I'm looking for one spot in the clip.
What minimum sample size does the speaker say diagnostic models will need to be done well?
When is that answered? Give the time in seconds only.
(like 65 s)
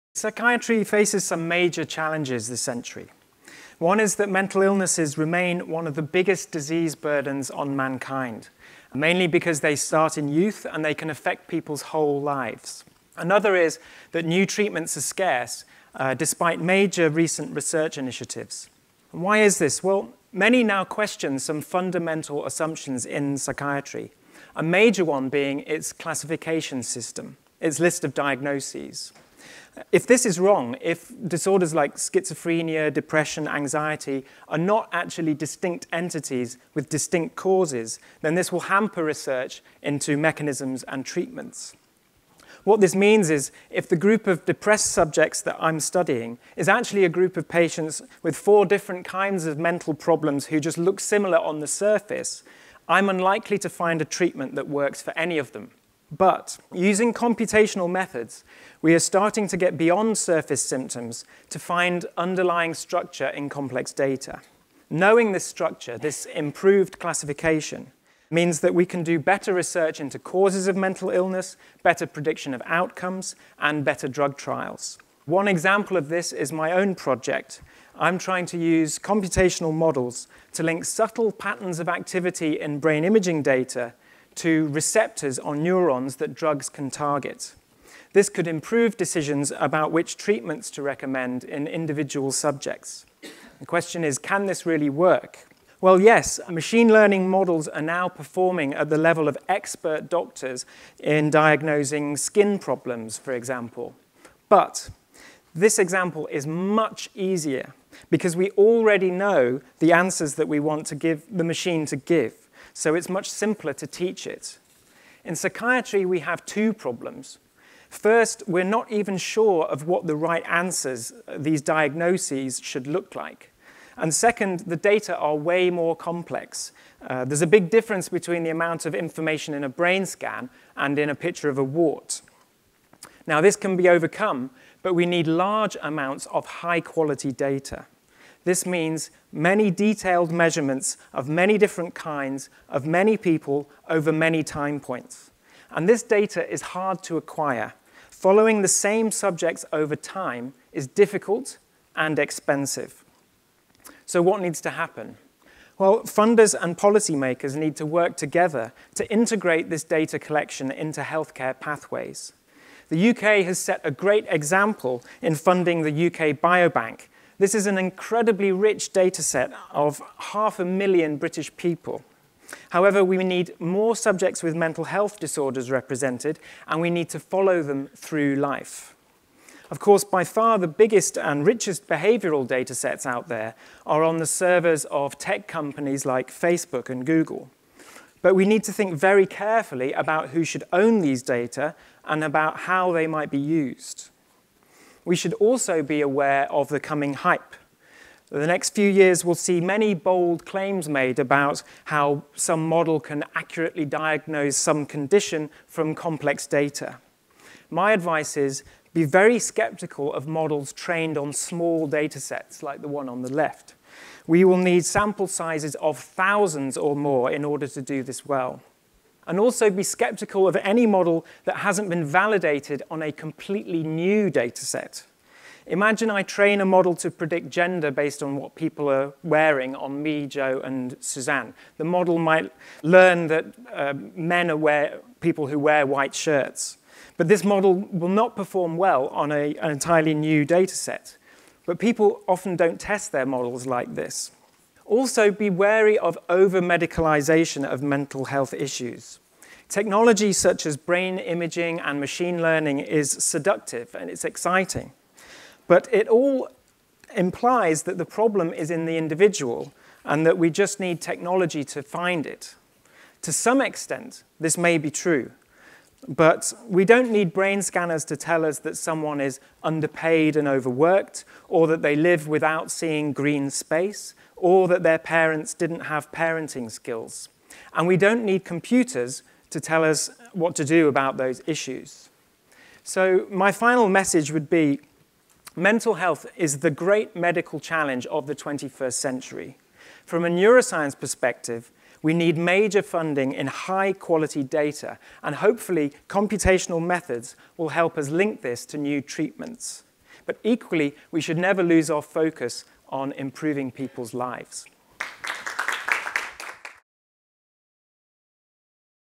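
215 s.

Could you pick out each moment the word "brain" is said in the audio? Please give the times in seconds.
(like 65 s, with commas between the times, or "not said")
82 s, 129 s, 250 s, 267 s.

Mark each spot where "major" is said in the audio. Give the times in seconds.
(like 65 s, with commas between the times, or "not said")
1 s, 16 s, 24 s, 292 s.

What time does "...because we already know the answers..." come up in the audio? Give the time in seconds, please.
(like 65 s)
108 s.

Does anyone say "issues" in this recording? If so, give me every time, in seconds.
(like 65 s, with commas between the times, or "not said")
248 s, 281 s.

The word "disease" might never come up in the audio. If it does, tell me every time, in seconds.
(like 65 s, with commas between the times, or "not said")
6 s.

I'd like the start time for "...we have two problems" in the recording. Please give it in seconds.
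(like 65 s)
116 s.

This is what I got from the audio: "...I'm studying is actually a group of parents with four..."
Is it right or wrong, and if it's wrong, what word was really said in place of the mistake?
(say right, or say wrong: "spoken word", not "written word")
wrong: "patients", not "parents".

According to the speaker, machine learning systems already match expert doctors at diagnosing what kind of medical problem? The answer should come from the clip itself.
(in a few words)
skin problems.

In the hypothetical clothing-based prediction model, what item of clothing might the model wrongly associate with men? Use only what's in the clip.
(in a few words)
white shirts.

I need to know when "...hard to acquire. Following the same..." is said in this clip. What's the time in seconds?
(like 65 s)
146 s.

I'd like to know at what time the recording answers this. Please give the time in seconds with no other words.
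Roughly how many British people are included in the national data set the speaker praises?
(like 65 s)
170 s.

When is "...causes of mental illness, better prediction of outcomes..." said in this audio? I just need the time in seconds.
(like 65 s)
70 s.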